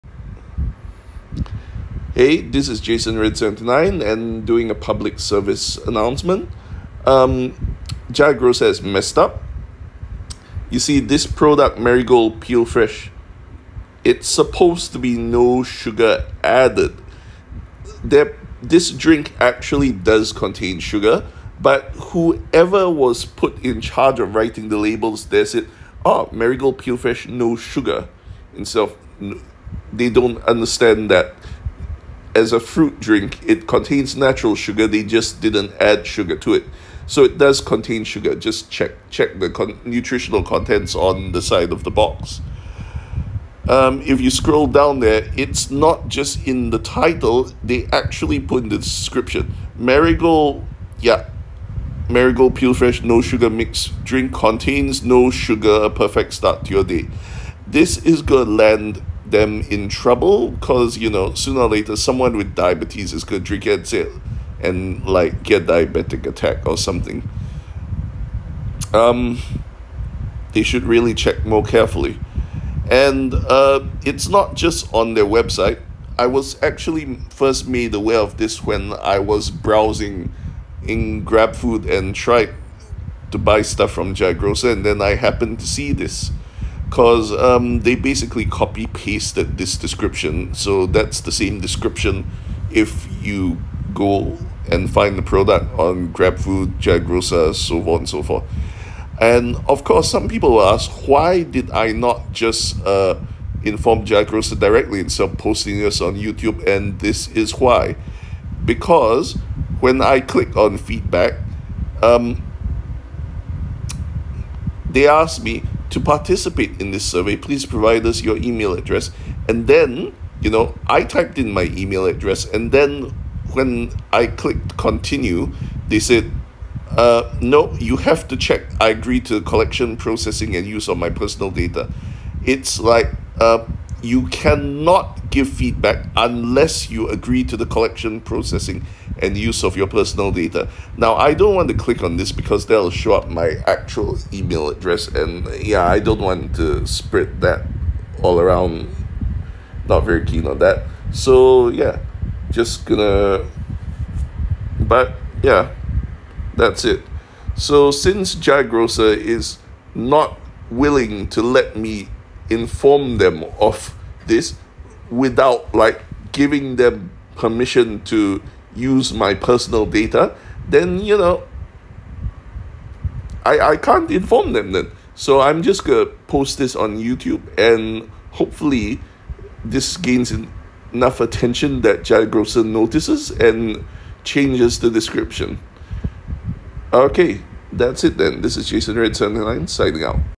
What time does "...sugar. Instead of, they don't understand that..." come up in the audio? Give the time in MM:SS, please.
00:27.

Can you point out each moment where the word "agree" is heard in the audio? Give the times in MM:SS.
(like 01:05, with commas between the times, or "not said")
02:08, 02:17.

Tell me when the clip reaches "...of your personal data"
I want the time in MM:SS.
02:19.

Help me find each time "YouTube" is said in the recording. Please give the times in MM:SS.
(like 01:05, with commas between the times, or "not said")
01:46, 02:56.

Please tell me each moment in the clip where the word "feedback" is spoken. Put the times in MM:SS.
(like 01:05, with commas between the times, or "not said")
01:50, 02:15.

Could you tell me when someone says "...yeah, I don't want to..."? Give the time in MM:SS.
02:25.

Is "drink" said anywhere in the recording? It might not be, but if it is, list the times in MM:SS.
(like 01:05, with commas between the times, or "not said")
00:18, 00:32, 00:54, 01:03.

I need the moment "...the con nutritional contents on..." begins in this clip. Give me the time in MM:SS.
00:39.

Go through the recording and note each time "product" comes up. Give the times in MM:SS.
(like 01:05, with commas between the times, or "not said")
00:11, 01:35.